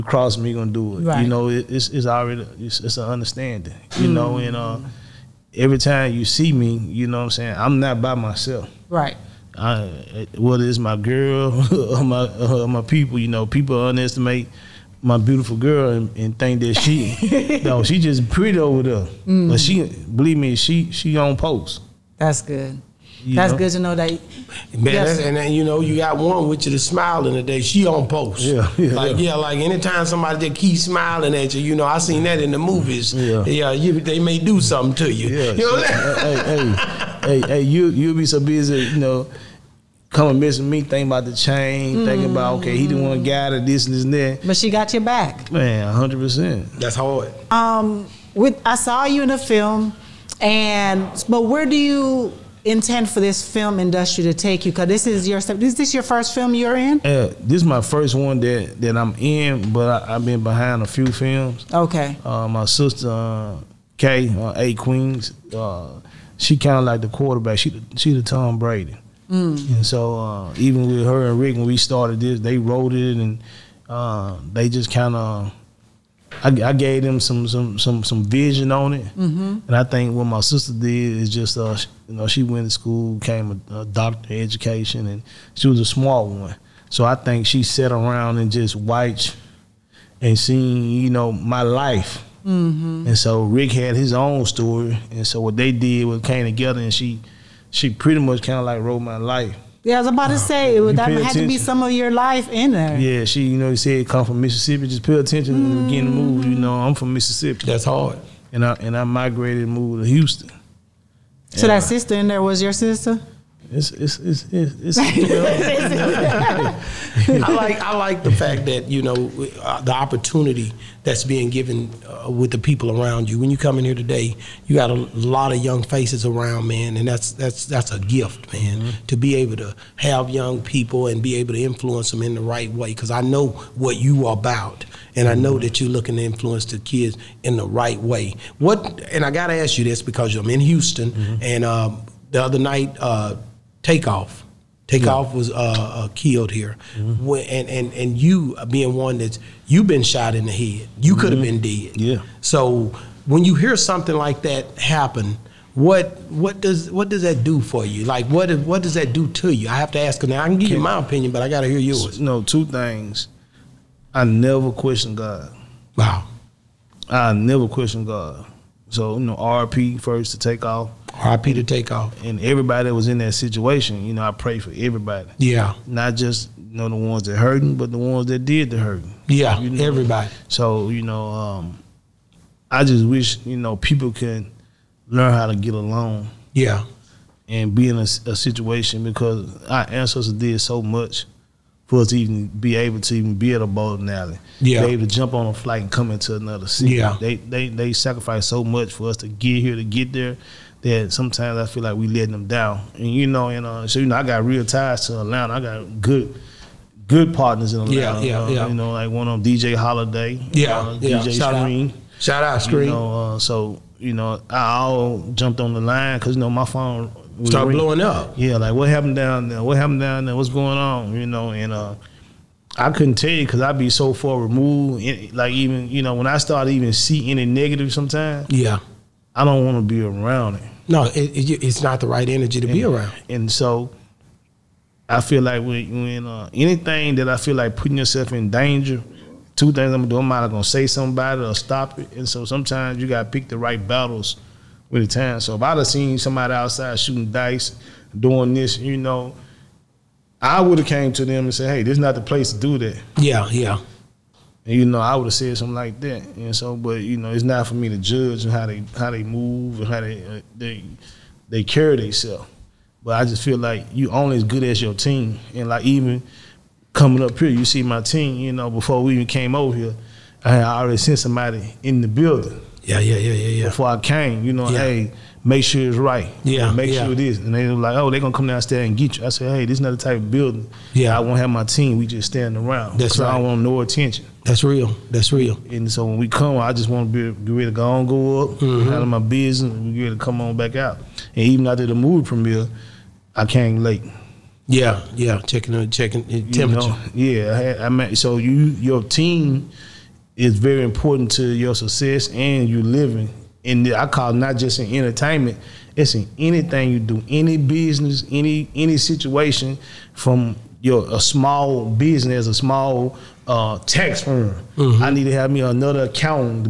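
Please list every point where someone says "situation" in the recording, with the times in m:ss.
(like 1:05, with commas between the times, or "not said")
2:53, 3:08, 5:08.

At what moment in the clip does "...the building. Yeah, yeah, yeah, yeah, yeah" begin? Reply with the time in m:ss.
4:32.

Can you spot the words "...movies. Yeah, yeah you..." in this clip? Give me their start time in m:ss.
0:32.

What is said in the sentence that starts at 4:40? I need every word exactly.
Yeah, I won't have my team.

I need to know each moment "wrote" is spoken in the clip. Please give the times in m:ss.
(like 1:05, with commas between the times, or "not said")
1:12, 1:38.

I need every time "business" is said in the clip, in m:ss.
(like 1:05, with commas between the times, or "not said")
4:49, 5:07, 5:11.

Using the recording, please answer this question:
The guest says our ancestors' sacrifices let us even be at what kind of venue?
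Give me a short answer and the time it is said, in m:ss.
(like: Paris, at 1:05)
a bowling alley, at 3:13.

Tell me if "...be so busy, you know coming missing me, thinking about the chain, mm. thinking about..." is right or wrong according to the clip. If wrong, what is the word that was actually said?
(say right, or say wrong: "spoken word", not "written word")
right.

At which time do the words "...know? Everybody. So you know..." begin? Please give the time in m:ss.
2:59.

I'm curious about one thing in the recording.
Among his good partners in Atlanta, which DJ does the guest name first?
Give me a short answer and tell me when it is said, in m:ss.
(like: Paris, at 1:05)
DJ Holiday, at 3:29.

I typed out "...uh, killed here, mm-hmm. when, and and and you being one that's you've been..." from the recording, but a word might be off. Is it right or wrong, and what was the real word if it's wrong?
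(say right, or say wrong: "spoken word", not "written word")
right.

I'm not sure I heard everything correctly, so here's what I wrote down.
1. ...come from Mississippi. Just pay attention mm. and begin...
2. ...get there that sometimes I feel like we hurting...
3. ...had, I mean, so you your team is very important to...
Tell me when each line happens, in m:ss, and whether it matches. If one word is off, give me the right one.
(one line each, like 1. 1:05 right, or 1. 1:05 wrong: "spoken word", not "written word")
1. 1:44 right
2. 3:19 wrong: "letting", not "hurting"
3. 4:57 right.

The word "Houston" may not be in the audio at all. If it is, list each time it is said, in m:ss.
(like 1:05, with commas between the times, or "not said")
1:50, 2:20.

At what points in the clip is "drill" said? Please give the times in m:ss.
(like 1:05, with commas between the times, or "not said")
not said.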